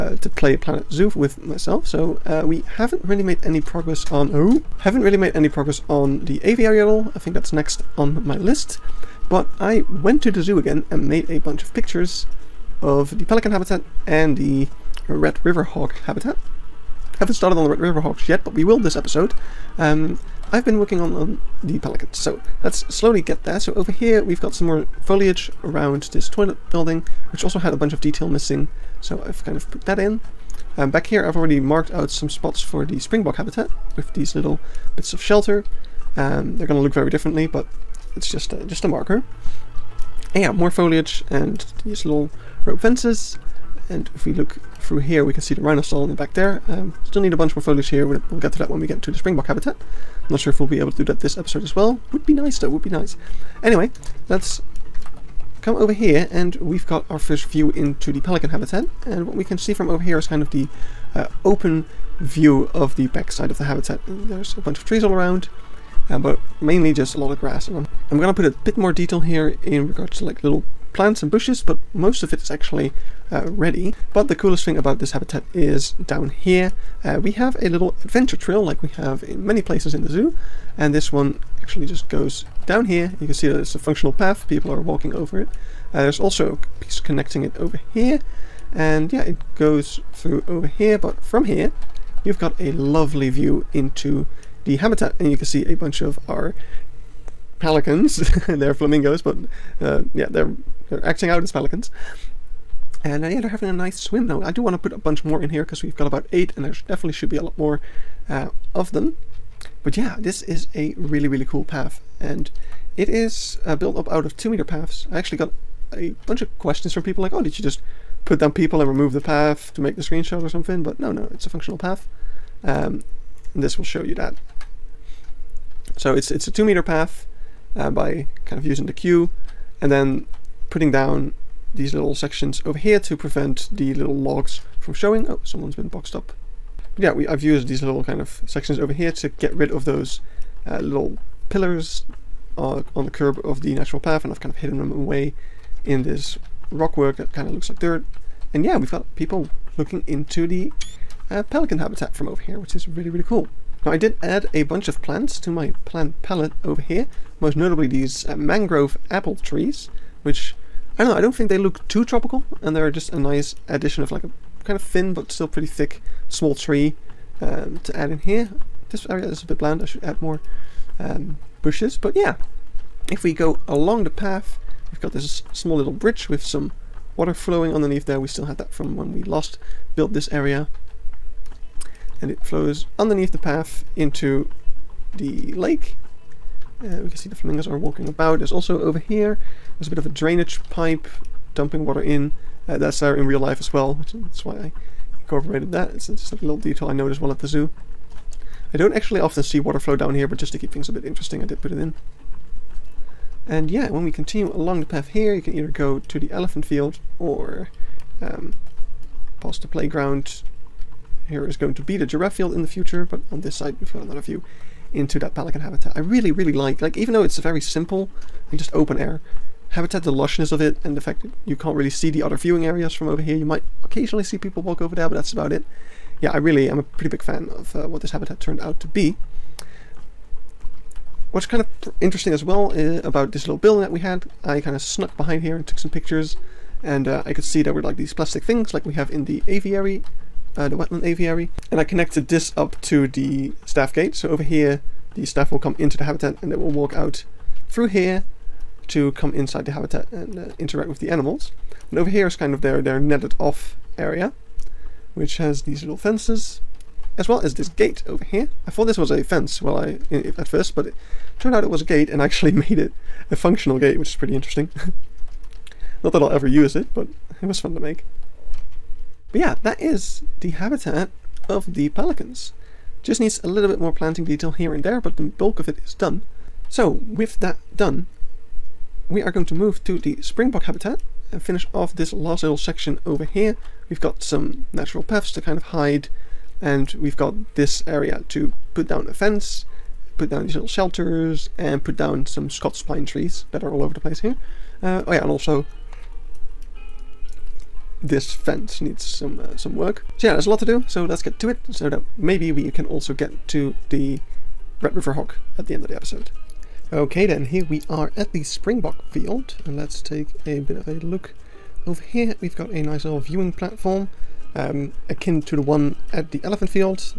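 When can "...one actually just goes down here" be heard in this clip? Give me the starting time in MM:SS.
01:21.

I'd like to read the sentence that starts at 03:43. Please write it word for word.
You might occasionally see people walk over there, but that's about it.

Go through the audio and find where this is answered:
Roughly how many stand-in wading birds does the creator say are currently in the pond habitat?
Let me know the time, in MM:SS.
01:46.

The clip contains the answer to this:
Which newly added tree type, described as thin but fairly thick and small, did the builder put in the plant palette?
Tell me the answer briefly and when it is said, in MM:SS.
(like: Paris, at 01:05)
Mangrove apple, at 02:38.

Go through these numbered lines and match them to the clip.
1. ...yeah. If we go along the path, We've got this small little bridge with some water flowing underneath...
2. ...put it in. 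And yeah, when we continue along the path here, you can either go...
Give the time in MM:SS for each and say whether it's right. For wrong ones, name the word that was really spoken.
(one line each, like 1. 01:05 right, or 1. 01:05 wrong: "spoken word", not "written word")
1. 02:52 right
2. 03:21 right.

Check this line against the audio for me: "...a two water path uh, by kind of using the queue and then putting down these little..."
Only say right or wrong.
wrong.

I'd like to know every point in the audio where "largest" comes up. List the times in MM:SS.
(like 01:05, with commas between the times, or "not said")
not said.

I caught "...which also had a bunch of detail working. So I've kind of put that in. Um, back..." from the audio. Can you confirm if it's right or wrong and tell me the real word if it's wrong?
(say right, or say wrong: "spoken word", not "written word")
wrong: "missing", not "working".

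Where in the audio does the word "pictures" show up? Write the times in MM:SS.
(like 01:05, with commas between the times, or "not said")
00:11, 03:55.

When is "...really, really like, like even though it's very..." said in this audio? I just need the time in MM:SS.
03:35.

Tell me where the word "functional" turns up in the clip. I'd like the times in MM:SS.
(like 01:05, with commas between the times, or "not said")
01:23, 02:01, 04:23.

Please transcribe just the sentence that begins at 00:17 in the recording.
Haven't started on the red river hogs yet, but we will this episode.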